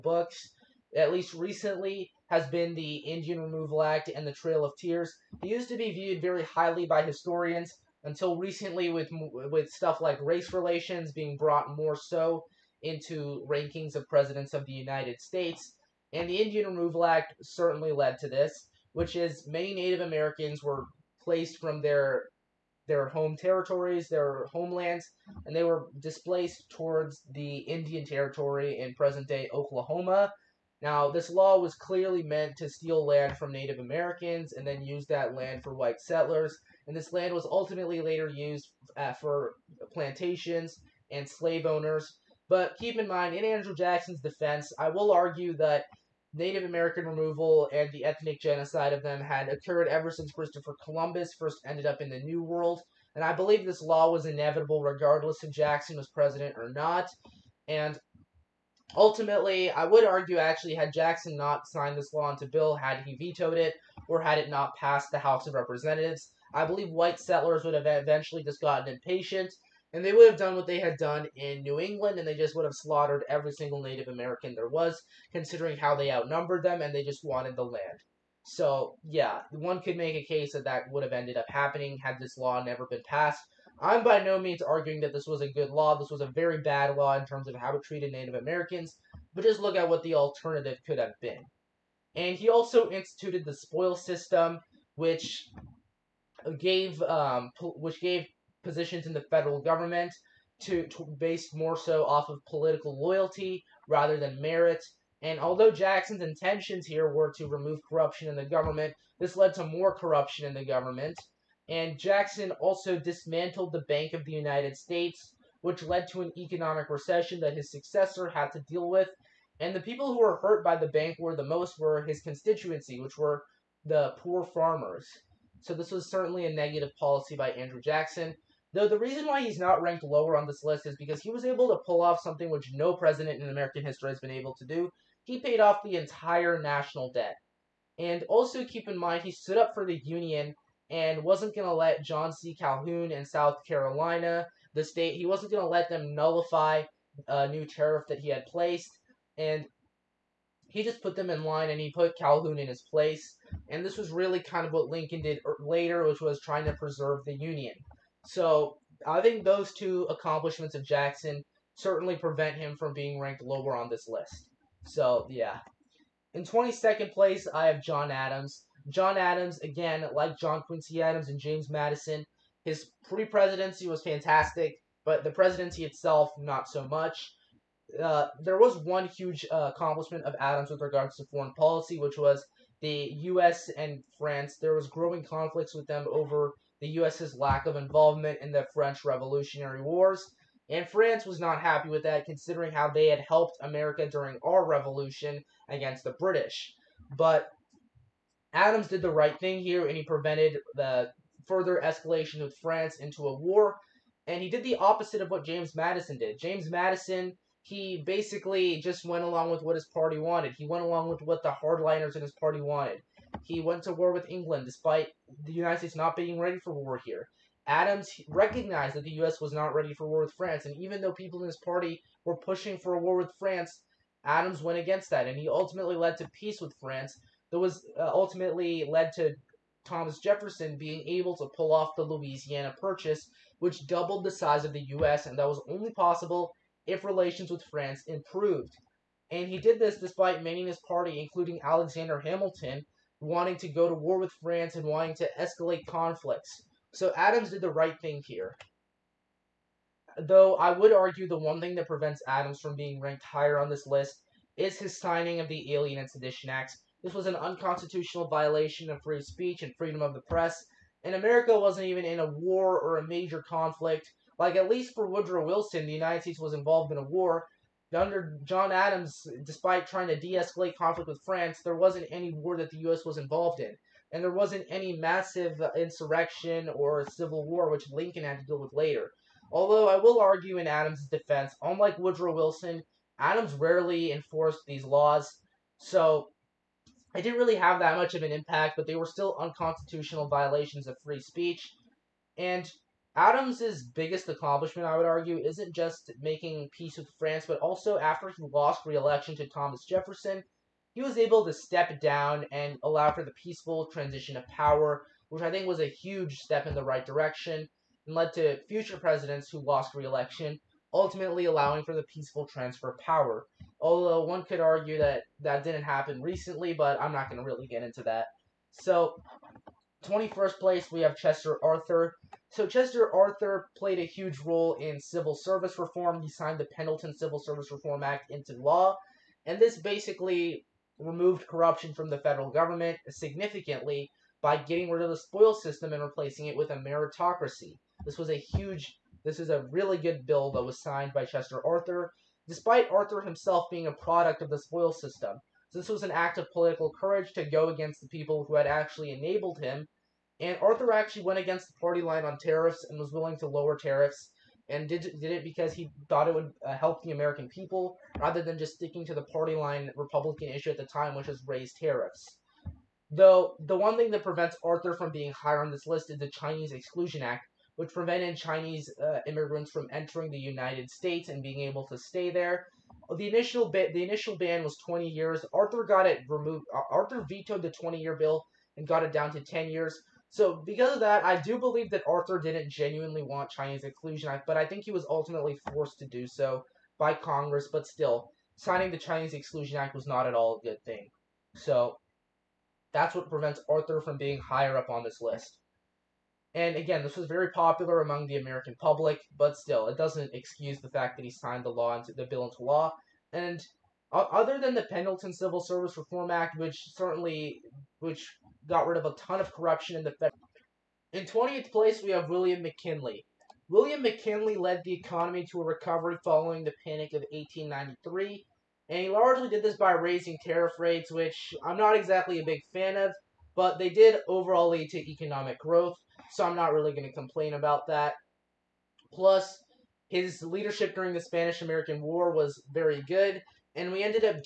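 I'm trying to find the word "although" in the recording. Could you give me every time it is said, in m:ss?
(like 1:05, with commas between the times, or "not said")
1:45, 4:39, 5:13.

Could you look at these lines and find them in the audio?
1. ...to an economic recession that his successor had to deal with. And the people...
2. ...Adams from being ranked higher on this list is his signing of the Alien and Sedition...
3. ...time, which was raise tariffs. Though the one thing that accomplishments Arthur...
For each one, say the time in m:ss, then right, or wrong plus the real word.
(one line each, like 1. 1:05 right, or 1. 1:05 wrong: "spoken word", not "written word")
1. 1:56 right
2. 4:12 right
3. 6:00 wrong: "prevents", not "accomplishments".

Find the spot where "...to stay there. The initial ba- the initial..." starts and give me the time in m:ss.
6:11.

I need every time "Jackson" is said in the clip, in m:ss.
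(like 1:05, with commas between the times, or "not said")
0:43, 0:55, 1:00, 1:45, 1:51, 2:07, 2:40.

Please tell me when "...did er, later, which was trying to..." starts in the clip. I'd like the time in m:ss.
2:35.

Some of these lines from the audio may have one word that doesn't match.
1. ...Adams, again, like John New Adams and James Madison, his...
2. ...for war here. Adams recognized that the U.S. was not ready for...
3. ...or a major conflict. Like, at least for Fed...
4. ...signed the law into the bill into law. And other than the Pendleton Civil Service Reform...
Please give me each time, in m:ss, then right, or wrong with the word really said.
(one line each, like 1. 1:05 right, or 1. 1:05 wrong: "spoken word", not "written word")
1. 2:49 wrong: "Quincy", not "New"
2. 3:36 right
3. 4:22 wrong: "Woodrow", not "Fed"
4. 6:41 right.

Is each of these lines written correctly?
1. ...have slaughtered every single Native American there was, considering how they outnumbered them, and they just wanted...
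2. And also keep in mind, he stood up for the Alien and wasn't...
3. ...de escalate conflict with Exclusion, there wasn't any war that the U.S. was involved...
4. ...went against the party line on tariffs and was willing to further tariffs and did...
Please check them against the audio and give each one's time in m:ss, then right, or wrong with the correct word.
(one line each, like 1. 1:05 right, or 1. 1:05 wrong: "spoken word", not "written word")
1. 1:12 right
2. 2:17 wrong: "Union", not "Alien"
3. 4:30 wrong: "France", not "Exclusion"
4. 5:51 wrong: "lower", not "further".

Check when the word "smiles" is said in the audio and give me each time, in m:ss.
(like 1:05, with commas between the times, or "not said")
not said.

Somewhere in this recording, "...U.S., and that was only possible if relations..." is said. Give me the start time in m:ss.
3:54.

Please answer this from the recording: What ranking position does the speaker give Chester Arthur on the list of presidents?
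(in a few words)
21st.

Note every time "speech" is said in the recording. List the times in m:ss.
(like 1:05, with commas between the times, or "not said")
4:19, 4:51.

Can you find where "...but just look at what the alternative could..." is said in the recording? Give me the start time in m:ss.
1:29.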